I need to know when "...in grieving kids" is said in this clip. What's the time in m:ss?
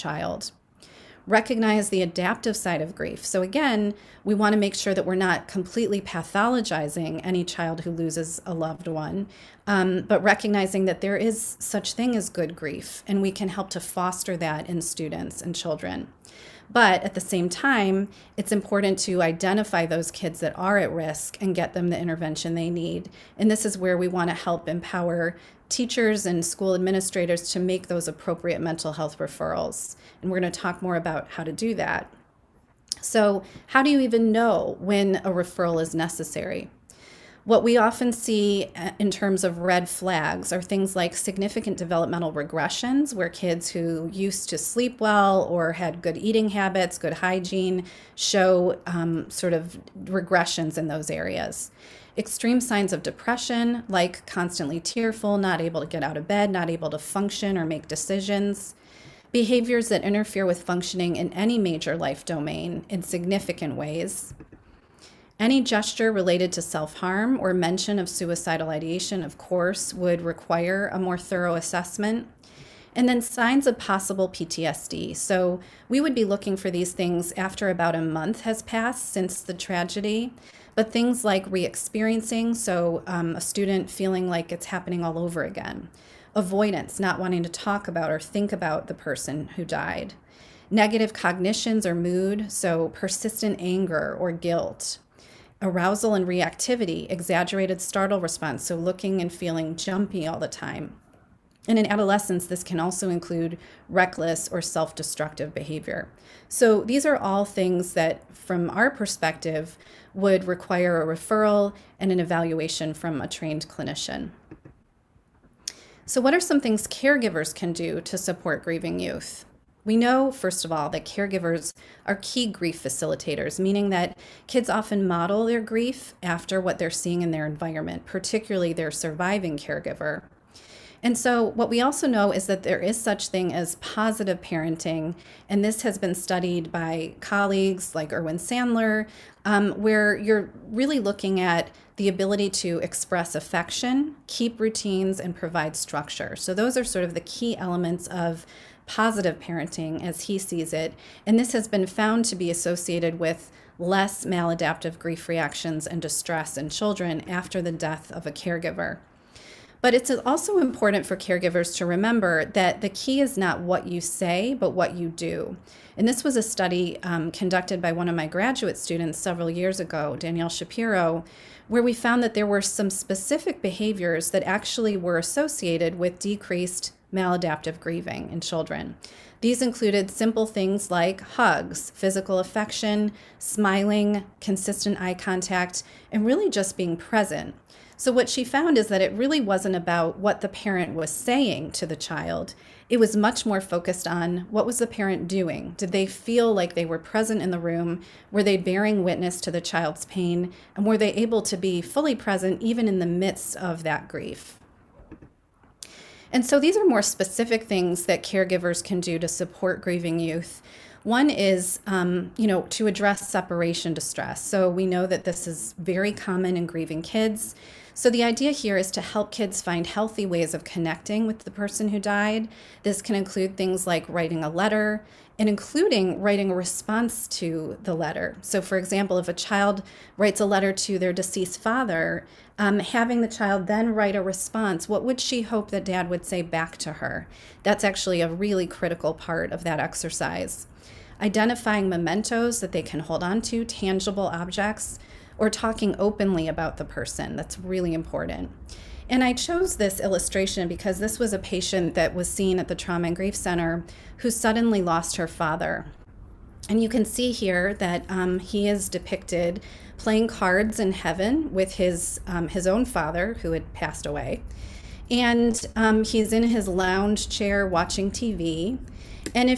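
3:36.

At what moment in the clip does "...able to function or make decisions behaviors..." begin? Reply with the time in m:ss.
0:56.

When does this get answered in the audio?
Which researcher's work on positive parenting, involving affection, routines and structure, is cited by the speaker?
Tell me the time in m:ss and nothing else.
2:18.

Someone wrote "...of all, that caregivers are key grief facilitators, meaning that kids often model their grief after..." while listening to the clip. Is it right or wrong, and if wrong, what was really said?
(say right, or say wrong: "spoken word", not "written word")
right.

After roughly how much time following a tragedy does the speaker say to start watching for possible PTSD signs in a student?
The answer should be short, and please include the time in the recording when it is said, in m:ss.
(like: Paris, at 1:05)
about a month, at 1:17.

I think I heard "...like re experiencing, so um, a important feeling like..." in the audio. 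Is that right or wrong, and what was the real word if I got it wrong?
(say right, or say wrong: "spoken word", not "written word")
wrong: "student", not "important".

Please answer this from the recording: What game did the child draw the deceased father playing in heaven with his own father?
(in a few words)
cards.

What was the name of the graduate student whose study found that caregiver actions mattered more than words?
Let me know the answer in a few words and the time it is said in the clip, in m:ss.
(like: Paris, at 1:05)
Danielle Shapiro, at 2:50.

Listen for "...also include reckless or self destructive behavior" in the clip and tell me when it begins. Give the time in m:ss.
1:42.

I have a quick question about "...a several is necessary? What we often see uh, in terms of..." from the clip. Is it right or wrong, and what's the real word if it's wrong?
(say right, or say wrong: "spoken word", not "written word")
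wrong: "referral", not "several".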